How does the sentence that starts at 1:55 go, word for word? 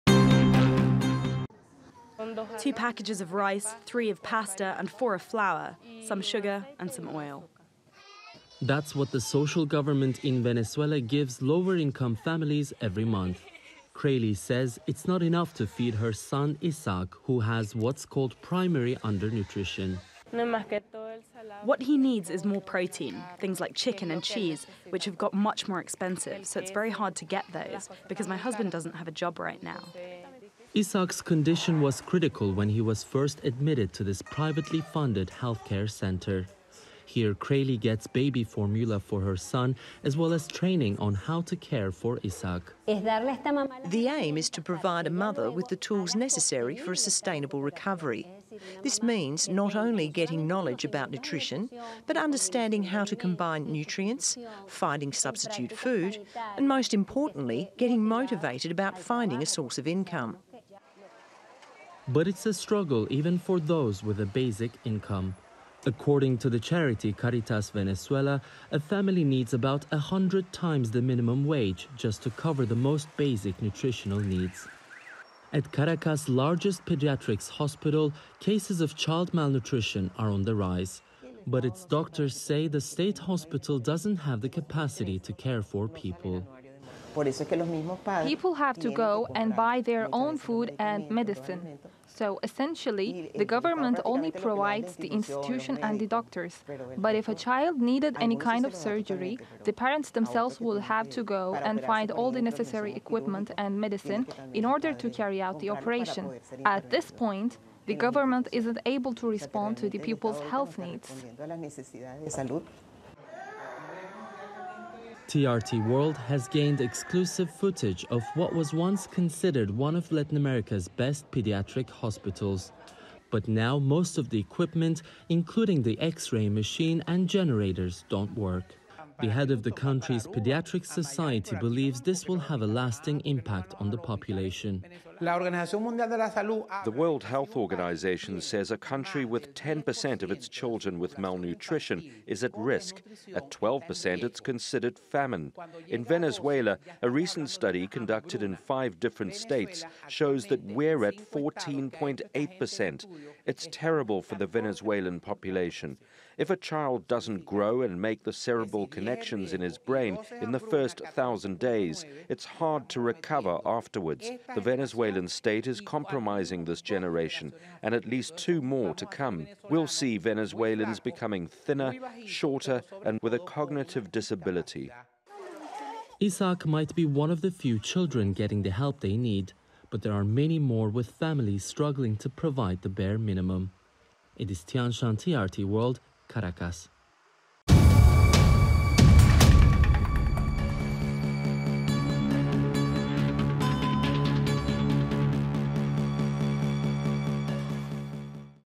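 TRT World has gained exclusive footage of what was once considered one of Latin America's best pediatric hospitals.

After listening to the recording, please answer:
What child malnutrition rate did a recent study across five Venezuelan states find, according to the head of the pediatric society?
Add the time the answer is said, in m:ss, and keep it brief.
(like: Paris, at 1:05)
14.8%, at 2:31.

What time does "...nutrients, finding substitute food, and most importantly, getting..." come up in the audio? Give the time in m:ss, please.
0:53.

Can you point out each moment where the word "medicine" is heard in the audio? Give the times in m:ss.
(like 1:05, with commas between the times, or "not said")
1:31, 1:43.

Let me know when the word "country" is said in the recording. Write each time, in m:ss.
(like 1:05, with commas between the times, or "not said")
2:09, 2:18.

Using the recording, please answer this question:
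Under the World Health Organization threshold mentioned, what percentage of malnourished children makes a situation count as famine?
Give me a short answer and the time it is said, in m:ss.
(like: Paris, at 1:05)
12%, at 2:23.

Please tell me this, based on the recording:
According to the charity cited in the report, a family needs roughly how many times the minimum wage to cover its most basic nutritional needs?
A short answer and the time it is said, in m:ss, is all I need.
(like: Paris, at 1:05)
100 times, at 1:09.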